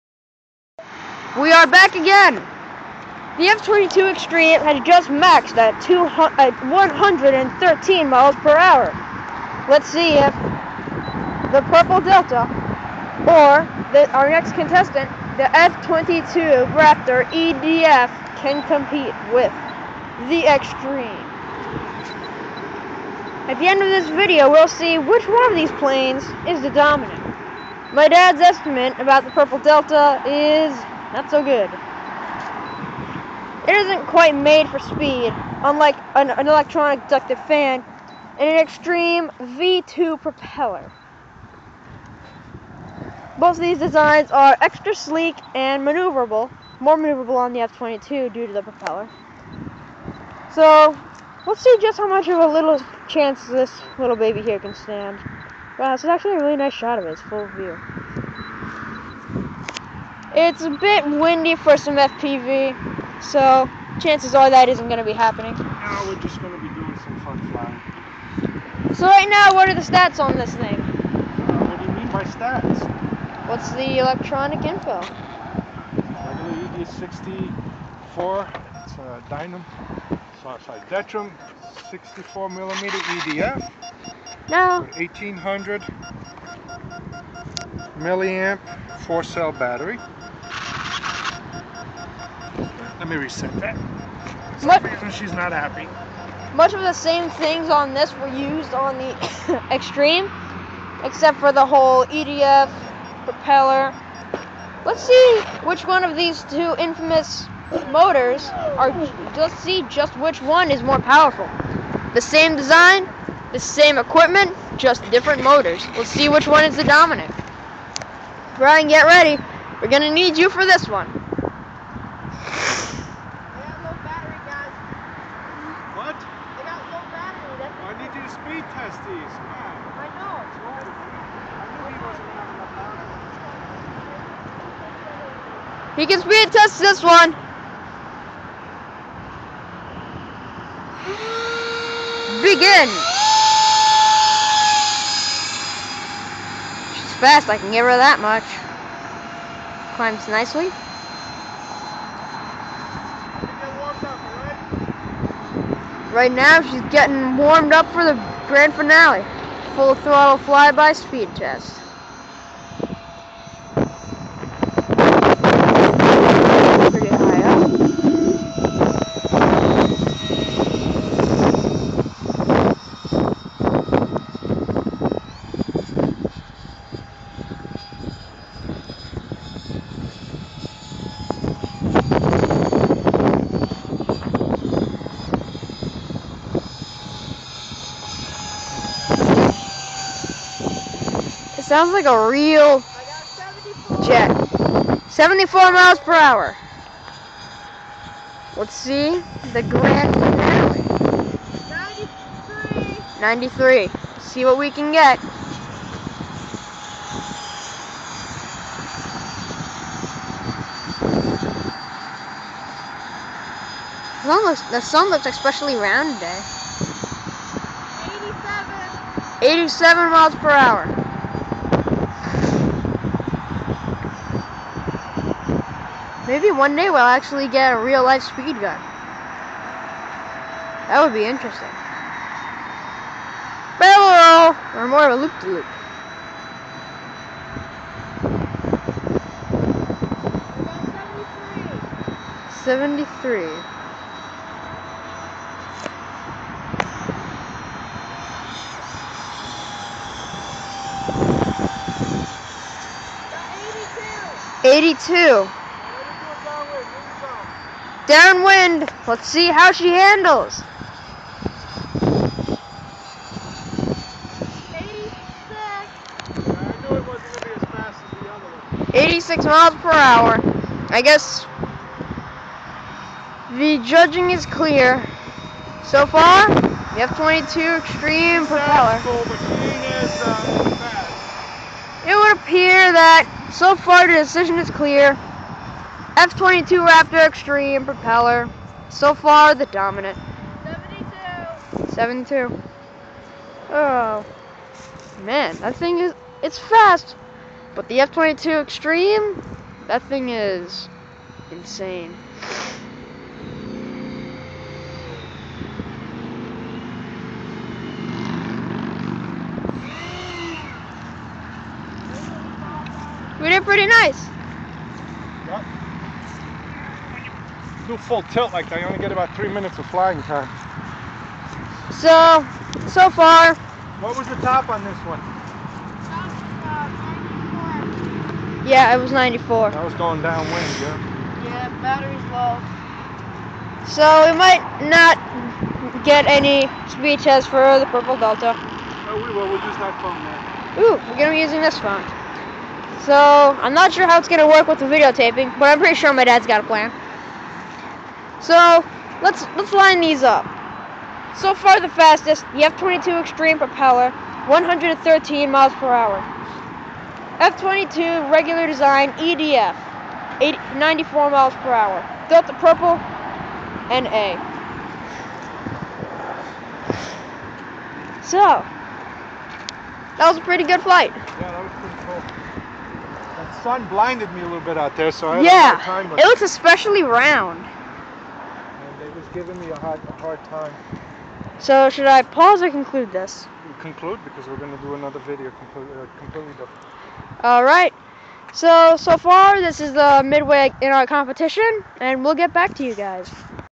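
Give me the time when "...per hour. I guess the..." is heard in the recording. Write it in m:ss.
4:29.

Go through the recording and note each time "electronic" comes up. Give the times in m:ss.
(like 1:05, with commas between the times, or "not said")
0:36, 1:13.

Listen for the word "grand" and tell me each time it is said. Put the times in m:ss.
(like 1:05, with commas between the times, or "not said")
2:38, 3:19.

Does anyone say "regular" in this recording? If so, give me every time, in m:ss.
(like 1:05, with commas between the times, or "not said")
1:15, 5:58.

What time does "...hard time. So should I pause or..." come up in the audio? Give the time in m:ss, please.
6:20.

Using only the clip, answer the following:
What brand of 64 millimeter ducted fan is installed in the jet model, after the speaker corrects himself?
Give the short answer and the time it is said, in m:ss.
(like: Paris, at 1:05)
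Detrum, at 1:20.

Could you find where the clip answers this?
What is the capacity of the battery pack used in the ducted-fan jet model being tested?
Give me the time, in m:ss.
1:24.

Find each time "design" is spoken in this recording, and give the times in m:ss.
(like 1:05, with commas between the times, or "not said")
0:43, 1:52, 5:58.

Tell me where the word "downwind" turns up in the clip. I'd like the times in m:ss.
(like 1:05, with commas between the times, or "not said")
4:18, 5:30.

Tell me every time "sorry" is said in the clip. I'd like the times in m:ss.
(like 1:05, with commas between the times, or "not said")
1:20.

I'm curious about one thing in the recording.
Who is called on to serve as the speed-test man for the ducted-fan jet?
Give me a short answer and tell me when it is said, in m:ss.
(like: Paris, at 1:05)
Brian, at 1:58.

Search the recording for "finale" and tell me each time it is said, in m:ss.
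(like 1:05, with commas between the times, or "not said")
2:38, 3:20.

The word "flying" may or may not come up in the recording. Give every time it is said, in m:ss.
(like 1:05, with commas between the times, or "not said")
1:07, 5:19.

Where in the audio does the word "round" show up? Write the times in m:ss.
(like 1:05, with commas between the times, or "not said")
3:35, 6:17.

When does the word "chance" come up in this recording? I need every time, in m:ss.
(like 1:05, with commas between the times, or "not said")
0:53, 1:03.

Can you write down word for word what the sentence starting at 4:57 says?
But the F-22 Extreme, that thing is insane.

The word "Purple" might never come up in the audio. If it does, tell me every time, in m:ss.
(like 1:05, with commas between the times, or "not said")
0:11, 0:29, 5:37, 6:02.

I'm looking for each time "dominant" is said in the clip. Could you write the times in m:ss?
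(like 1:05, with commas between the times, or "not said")
0:26, 1:56, 4:49.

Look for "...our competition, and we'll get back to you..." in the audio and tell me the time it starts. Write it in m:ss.
6:30.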